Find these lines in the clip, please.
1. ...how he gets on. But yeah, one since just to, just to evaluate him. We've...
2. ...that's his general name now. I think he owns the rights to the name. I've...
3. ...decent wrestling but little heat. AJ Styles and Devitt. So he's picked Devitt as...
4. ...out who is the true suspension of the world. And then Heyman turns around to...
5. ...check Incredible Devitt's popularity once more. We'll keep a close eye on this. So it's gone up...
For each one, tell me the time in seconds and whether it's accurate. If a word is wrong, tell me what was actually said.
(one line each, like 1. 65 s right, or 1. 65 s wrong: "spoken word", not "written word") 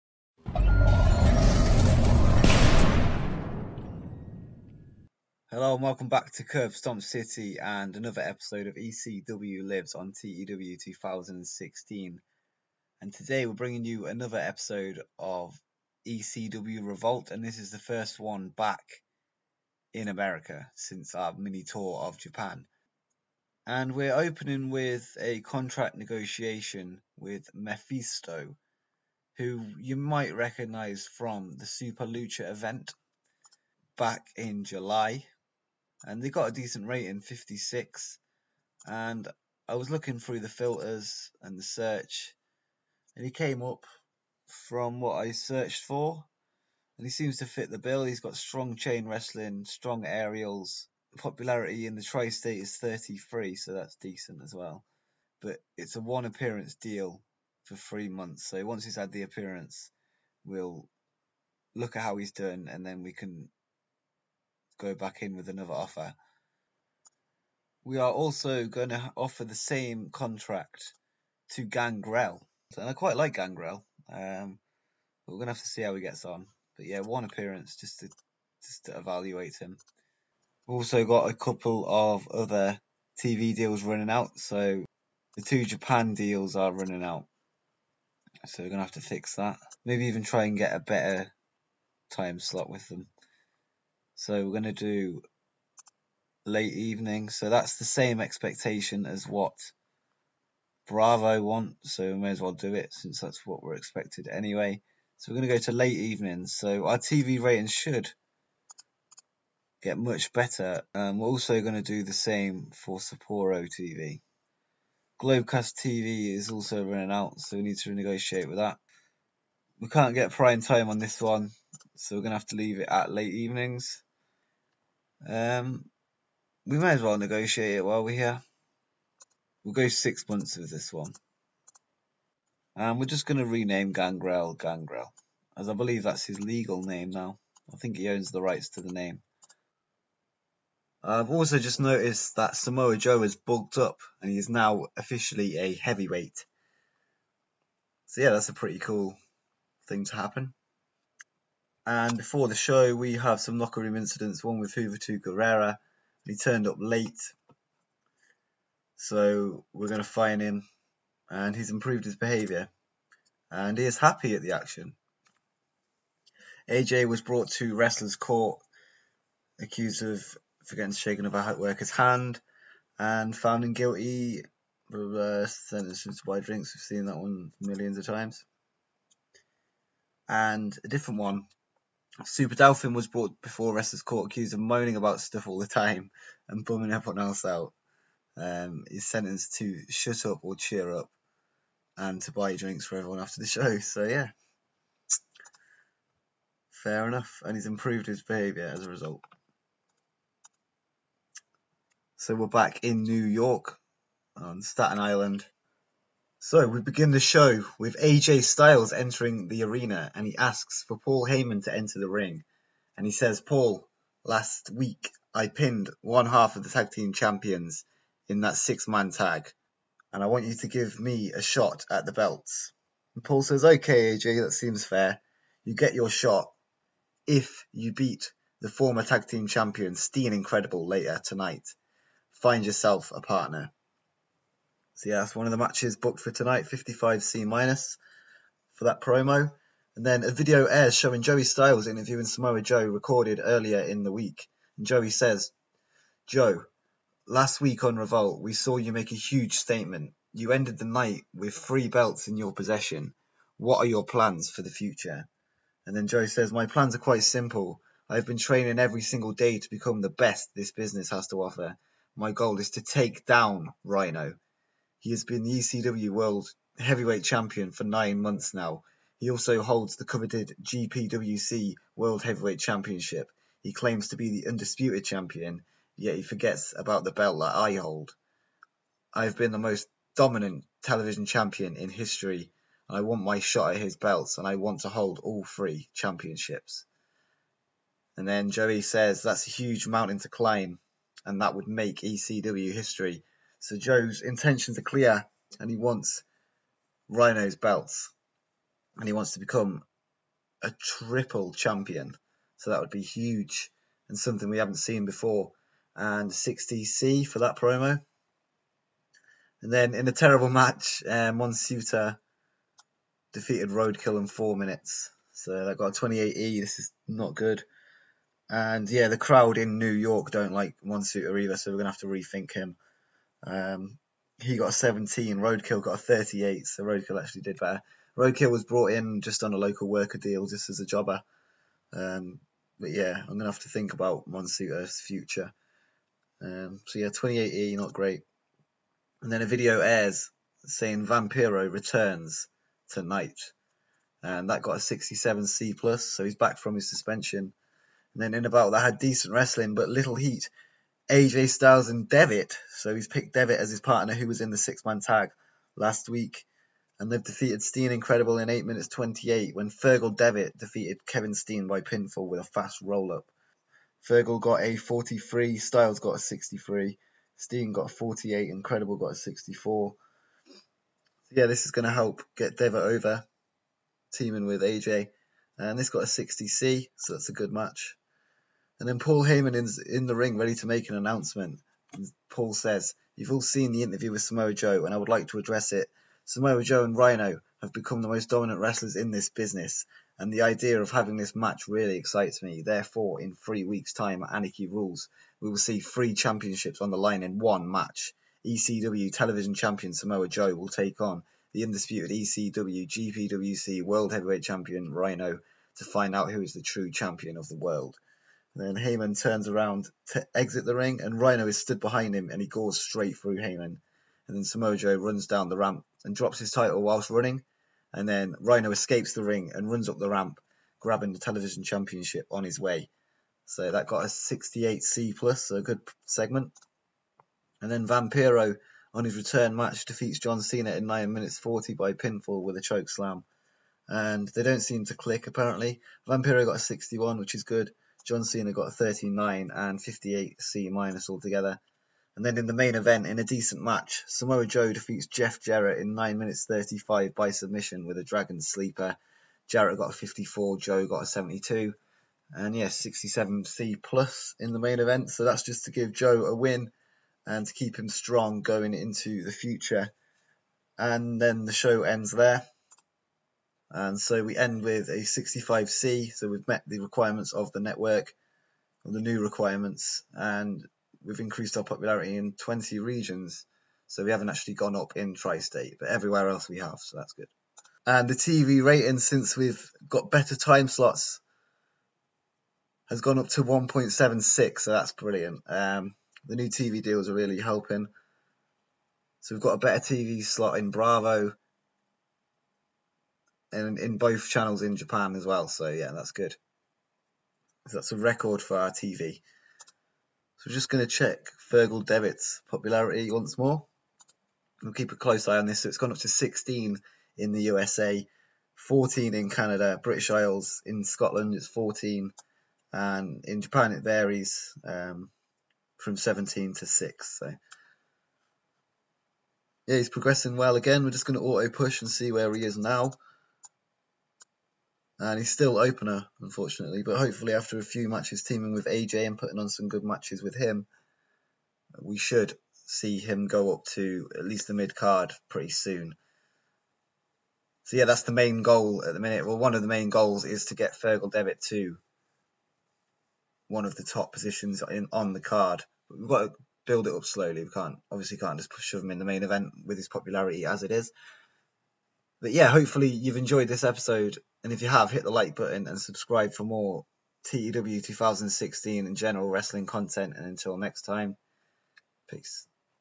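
1. 75 s wrong: "appearance", not "since"
2. 136 s wrong: "legal", not "general"
3. 348 s right
4. 406 s wrong: "champion", not "suspension"
5. 500 s wrong: "Fergal", not "Incredible".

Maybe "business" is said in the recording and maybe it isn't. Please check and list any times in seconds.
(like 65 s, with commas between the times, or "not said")
260 s, 389 s.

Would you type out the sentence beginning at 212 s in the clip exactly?
And he says, Paul, last week I pinned one half of the tag team champions in that six man tag.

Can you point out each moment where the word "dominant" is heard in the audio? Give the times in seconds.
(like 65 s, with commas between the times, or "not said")
280 s, 388 s.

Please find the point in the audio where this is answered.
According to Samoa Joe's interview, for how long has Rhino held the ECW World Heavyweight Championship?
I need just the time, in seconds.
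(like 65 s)
267 s.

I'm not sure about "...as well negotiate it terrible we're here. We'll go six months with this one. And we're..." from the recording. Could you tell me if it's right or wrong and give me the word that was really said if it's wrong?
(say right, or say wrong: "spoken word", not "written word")
wrong: "while", not "terrible".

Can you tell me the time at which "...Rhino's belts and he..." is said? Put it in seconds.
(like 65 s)
297 s.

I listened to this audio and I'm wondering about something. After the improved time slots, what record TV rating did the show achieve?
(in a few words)
1.76.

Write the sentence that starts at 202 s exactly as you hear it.
So, we're back in New York on Staten Island.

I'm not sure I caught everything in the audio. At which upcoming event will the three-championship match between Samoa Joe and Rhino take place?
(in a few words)
Anarchy Rulz.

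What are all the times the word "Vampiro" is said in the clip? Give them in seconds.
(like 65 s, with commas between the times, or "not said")
341 s, 427 s, 436 s.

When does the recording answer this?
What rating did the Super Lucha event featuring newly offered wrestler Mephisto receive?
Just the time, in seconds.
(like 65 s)
37 s.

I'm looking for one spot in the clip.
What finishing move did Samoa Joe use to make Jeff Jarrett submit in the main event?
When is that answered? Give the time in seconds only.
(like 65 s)
448 s.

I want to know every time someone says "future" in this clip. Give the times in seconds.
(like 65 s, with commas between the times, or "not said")
254 s, 334 s, 459 s.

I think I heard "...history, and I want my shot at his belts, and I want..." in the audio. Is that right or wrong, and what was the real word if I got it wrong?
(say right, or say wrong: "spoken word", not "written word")
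right.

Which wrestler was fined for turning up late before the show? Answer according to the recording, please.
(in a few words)
Juventud Guerrera.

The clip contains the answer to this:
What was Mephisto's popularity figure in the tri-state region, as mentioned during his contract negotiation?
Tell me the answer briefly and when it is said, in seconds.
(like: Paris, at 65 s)
33, at 52 s.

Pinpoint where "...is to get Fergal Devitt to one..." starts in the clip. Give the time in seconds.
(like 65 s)
540 s.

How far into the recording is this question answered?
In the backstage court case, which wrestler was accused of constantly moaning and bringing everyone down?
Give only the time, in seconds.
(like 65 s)
182 s.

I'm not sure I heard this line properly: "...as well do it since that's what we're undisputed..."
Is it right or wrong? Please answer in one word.
wrong.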